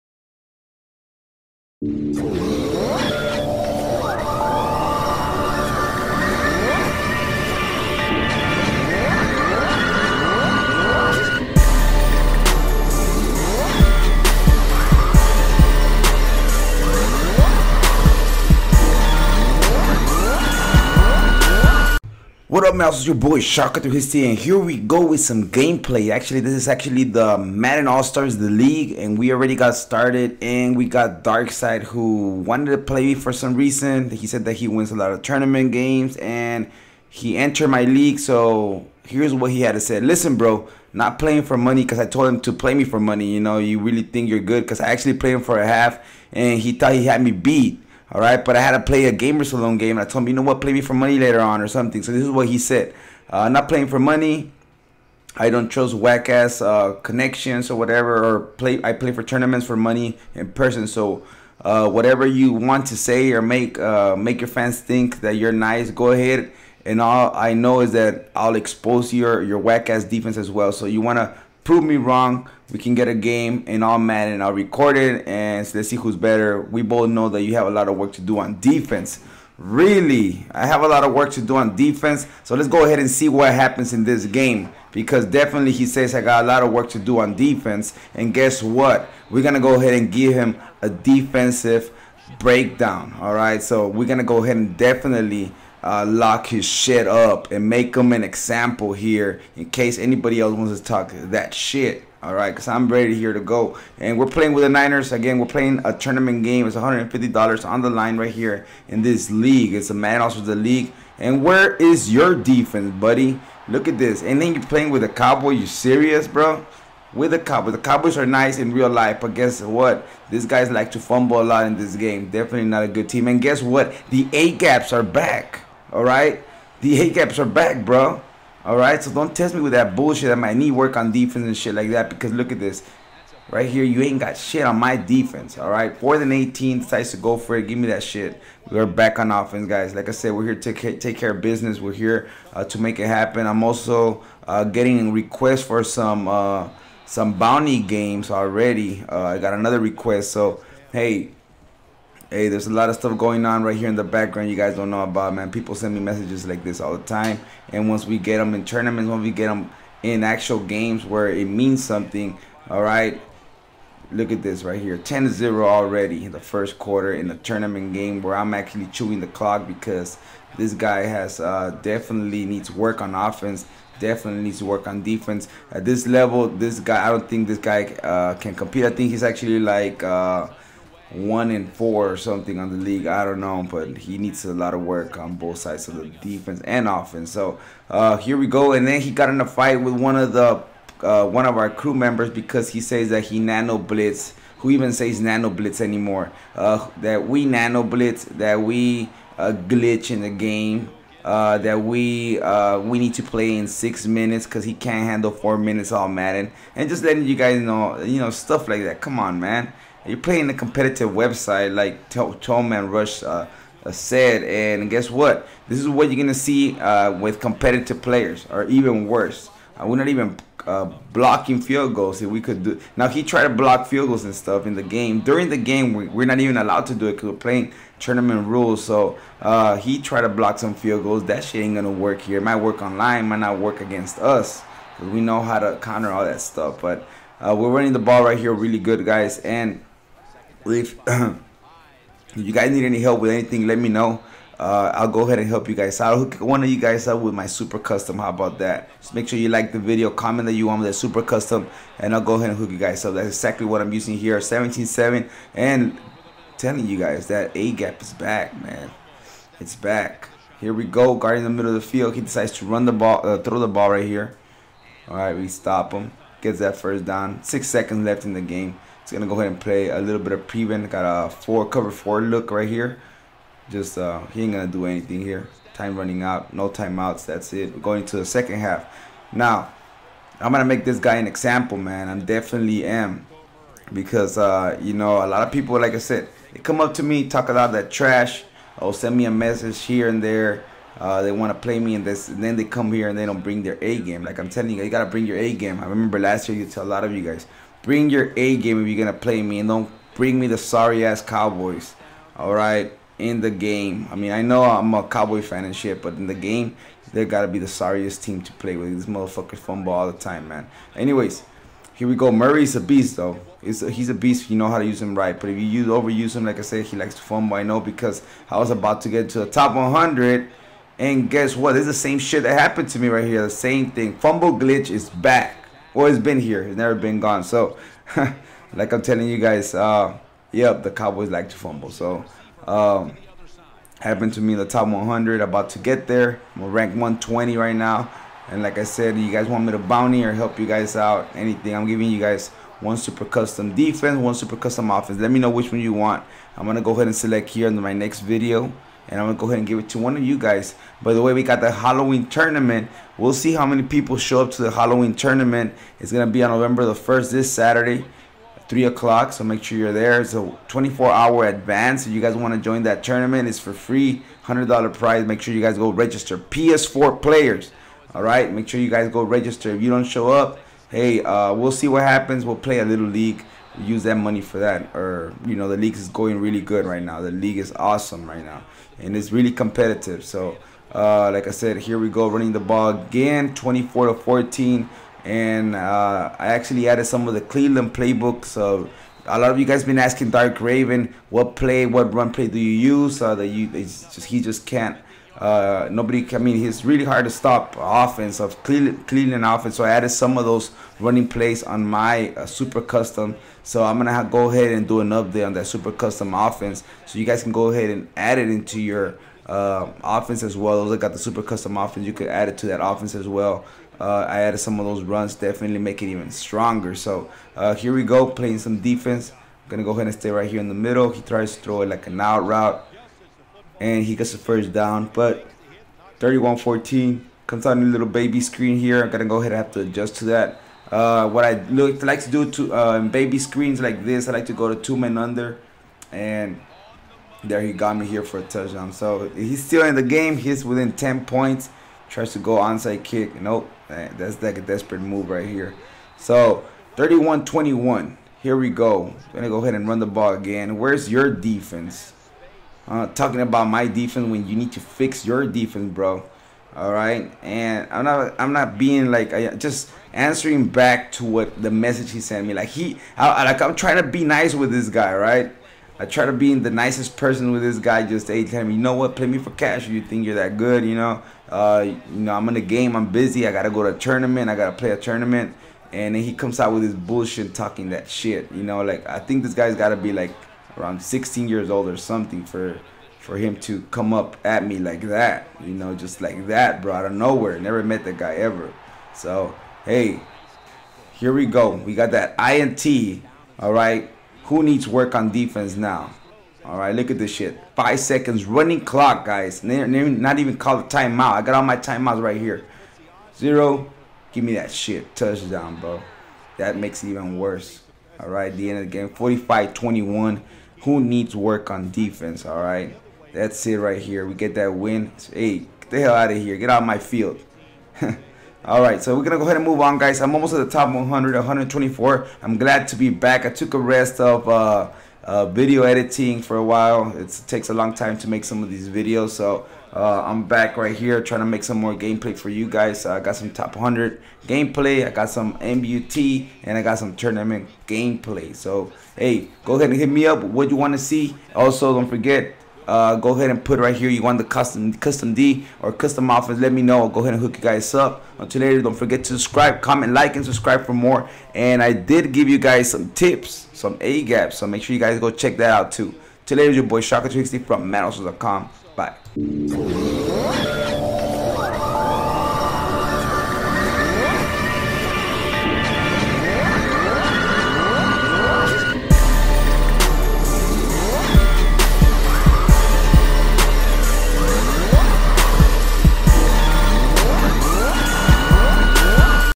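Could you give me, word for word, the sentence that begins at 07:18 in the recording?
So he's still in the game.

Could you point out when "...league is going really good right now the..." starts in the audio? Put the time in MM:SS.
06:15.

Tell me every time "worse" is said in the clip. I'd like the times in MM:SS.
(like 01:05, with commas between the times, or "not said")
03:39, 08:27.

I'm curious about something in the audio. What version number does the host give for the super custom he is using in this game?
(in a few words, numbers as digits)
17.7.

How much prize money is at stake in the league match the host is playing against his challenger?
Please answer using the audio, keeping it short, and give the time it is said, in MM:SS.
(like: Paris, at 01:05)
$150, at 01:46.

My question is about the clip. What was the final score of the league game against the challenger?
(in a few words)
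45-21.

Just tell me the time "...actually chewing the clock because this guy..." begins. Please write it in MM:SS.
02:48.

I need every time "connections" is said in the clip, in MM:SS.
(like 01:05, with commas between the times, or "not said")
00:57.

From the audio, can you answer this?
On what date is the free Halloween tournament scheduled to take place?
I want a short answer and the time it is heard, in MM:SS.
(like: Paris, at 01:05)
November 1, at 05:56.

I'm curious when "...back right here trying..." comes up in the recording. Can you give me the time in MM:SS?
08:50.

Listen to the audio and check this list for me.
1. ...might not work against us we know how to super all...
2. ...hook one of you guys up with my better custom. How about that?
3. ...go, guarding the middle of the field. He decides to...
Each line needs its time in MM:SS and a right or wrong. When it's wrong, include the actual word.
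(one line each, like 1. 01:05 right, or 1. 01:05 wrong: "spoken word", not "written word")
1. 03:53 wrong: "counter", not "super"
2. 04:06 wrong: "super", not "better"
3. 04:20 right.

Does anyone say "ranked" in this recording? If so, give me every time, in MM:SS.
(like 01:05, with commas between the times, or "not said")
05:36.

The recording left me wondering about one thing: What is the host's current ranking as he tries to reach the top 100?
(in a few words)
120.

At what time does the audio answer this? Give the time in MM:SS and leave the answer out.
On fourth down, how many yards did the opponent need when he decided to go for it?
02:15.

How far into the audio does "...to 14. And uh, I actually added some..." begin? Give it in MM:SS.
06:24.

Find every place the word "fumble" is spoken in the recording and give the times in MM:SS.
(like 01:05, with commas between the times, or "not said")
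02:00, 05:09, 05:17, 05:24, 05:31.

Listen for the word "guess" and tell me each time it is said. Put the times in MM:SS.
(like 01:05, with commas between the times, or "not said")
01:28, 01:59, 02:03, 03:34, 05:21.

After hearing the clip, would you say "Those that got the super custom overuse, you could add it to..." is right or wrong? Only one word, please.
wrong.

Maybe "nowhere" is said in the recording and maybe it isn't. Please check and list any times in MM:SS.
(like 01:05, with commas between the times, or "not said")
08:07.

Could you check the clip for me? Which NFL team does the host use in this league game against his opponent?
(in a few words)
Niners.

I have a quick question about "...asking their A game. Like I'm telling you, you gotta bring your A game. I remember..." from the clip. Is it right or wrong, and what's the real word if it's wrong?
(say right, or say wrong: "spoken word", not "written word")
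wrong: "bring", not "asking".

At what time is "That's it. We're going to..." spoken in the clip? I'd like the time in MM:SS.
04:37.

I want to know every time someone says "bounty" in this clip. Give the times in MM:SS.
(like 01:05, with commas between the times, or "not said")
02:27, 05:39.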